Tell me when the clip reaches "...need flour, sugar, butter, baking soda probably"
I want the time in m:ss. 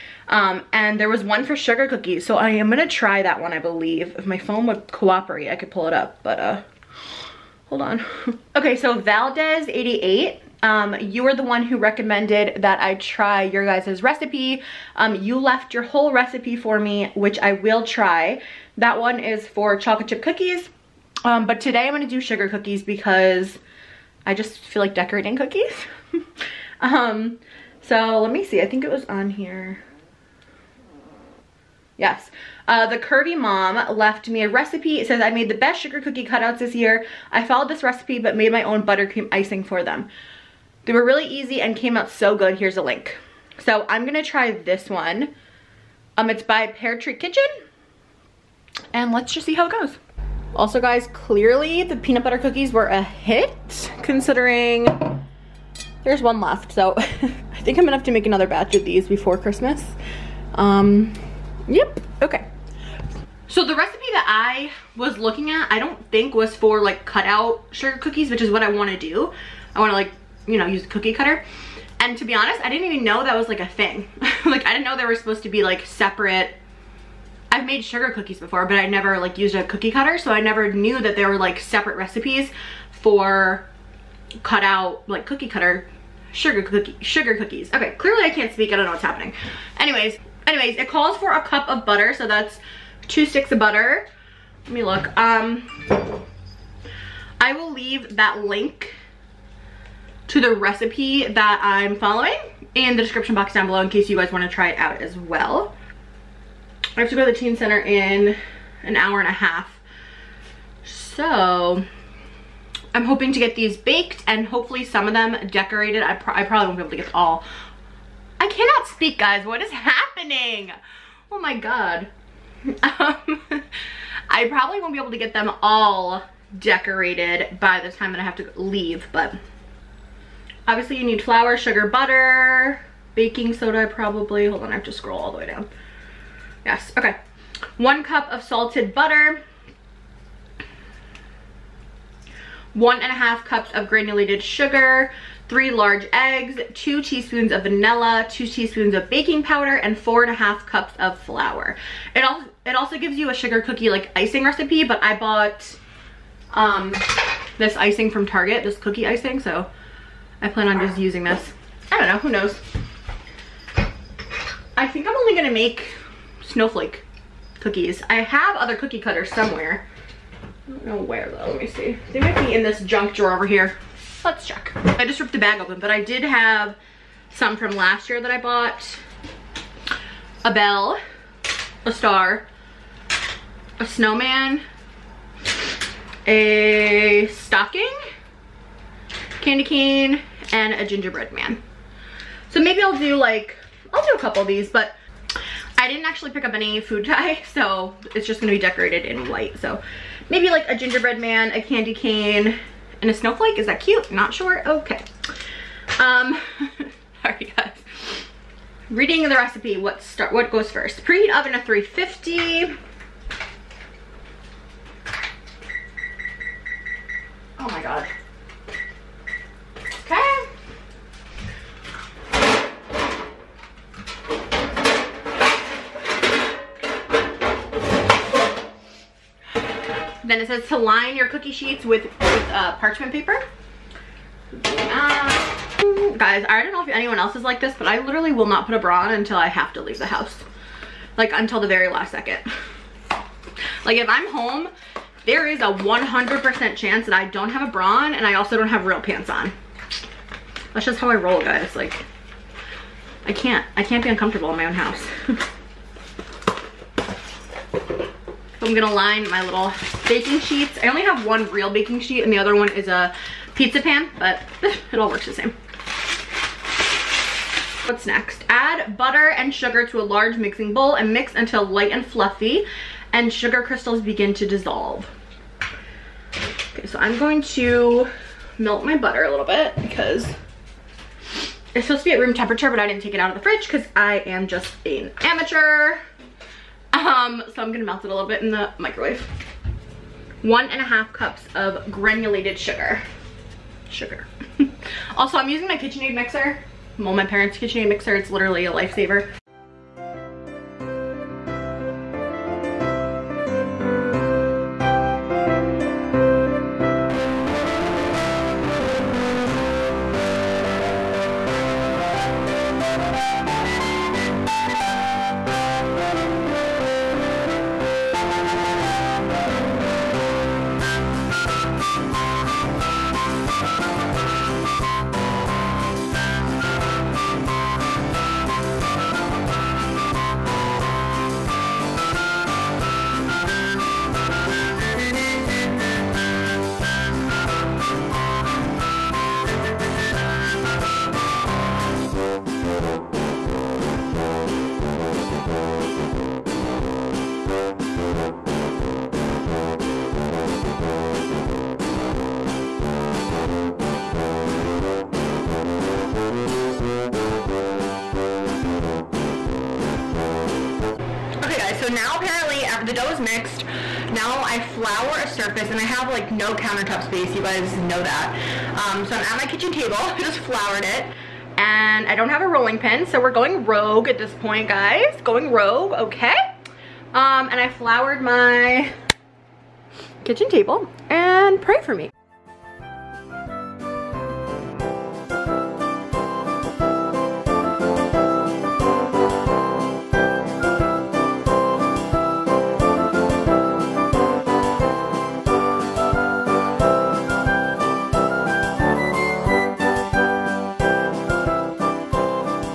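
2:11.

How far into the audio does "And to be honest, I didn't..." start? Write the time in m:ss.
1:12.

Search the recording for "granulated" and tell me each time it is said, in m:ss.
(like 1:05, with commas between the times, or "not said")
2:23, 4:51.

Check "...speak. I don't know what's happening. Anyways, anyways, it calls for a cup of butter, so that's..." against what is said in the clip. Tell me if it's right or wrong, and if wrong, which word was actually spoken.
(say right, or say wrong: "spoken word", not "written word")
right.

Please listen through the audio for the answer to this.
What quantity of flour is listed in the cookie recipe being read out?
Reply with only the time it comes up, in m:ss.
2:29.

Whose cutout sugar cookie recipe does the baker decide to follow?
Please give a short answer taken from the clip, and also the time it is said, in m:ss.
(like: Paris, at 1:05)
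Pear Tree Kitchen, at 0:46.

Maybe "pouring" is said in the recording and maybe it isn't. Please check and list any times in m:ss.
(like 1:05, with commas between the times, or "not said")
not said.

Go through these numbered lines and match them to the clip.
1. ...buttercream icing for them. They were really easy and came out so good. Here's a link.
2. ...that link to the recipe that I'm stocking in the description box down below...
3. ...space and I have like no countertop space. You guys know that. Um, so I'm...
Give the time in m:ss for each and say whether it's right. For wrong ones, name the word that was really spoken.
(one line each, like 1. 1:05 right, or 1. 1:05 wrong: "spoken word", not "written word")
1. 0:38 right
2. 1:38 wrong: "following", not "stocking"
3. 6:05 wrong: "surface", not "space".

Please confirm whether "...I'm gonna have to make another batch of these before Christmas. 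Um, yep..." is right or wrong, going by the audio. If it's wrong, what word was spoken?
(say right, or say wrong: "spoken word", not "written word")
right.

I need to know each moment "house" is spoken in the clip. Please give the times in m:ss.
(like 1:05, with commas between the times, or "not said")
4:00, 4:14.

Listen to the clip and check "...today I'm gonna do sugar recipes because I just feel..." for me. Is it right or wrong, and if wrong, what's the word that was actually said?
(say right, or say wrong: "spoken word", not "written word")
wrong: "cookies", not "recipes".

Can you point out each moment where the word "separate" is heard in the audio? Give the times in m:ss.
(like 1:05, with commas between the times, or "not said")
1:15, 1:21.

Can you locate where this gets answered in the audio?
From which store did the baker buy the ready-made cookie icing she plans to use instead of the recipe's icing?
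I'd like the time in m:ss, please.
2:38.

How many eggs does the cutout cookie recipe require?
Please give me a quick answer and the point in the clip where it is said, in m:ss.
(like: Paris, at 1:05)
3, at 2:25.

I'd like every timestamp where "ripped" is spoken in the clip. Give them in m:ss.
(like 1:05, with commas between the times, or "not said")
2:55.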